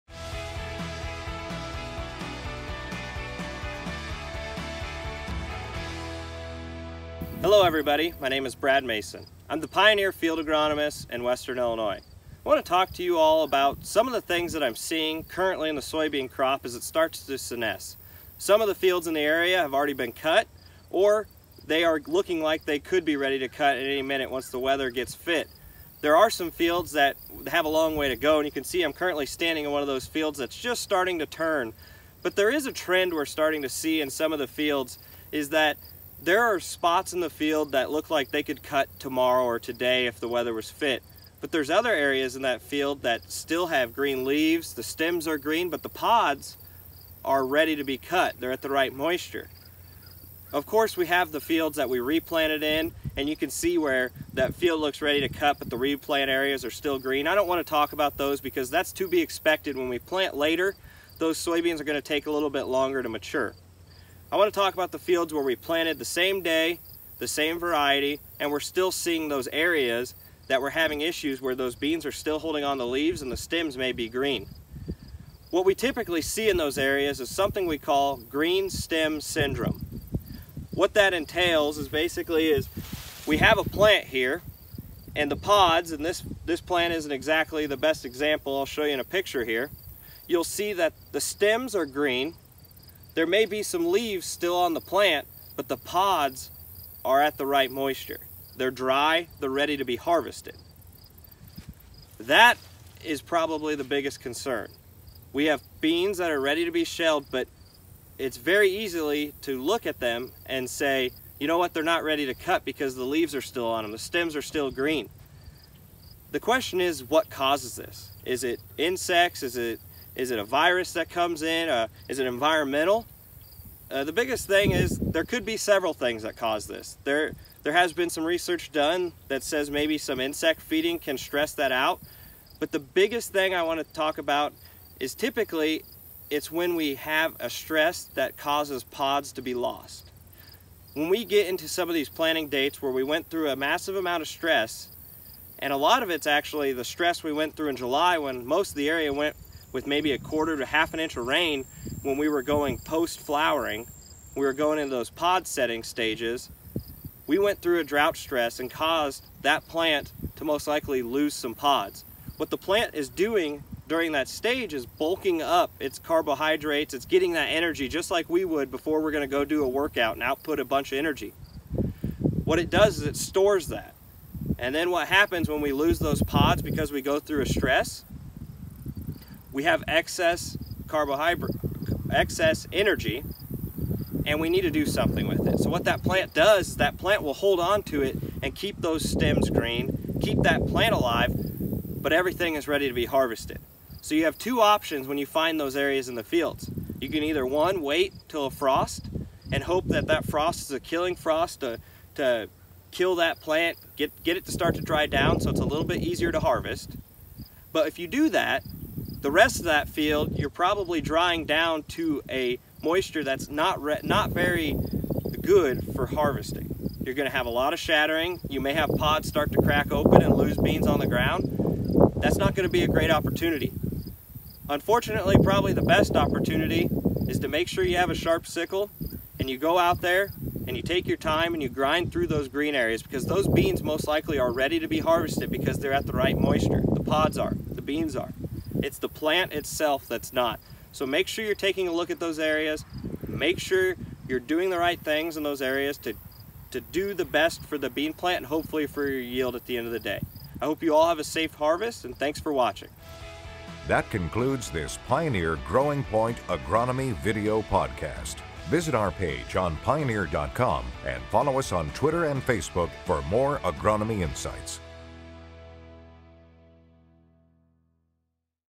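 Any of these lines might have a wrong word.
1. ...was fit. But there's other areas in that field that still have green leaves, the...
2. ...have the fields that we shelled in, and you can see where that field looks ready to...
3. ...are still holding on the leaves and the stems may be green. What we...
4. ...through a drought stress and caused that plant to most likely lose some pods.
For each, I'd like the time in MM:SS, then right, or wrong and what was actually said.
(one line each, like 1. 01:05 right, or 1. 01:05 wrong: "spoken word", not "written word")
1. 00:40 right
2. 00:51 wrong: "replanted", not "shelled"
3. 01:12 right
4. 02:37 right.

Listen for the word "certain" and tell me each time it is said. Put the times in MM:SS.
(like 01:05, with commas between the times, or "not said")
not said.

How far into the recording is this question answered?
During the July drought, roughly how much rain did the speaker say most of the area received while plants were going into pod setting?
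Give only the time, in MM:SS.
02:30.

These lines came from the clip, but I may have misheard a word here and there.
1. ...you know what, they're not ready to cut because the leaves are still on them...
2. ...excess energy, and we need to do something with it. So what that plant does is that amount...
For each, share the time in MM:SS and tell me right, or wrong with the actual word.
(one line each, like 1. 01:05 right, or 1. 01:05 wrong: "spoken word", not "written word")
1. 01:51 right
2. 03:02 wrong: "plant", not "amount".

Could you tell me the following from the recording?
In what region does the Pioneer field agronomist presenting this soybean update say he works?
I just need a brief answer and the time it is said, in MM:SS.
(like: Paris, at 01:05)
Western Illinois, at 00:11.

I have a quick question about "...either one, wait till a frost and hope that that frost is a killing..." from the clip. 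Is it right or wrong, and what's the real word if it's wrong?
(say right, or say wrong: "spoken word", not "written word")
right.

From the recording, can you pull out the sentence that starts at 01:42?
That is probably the biggest concern.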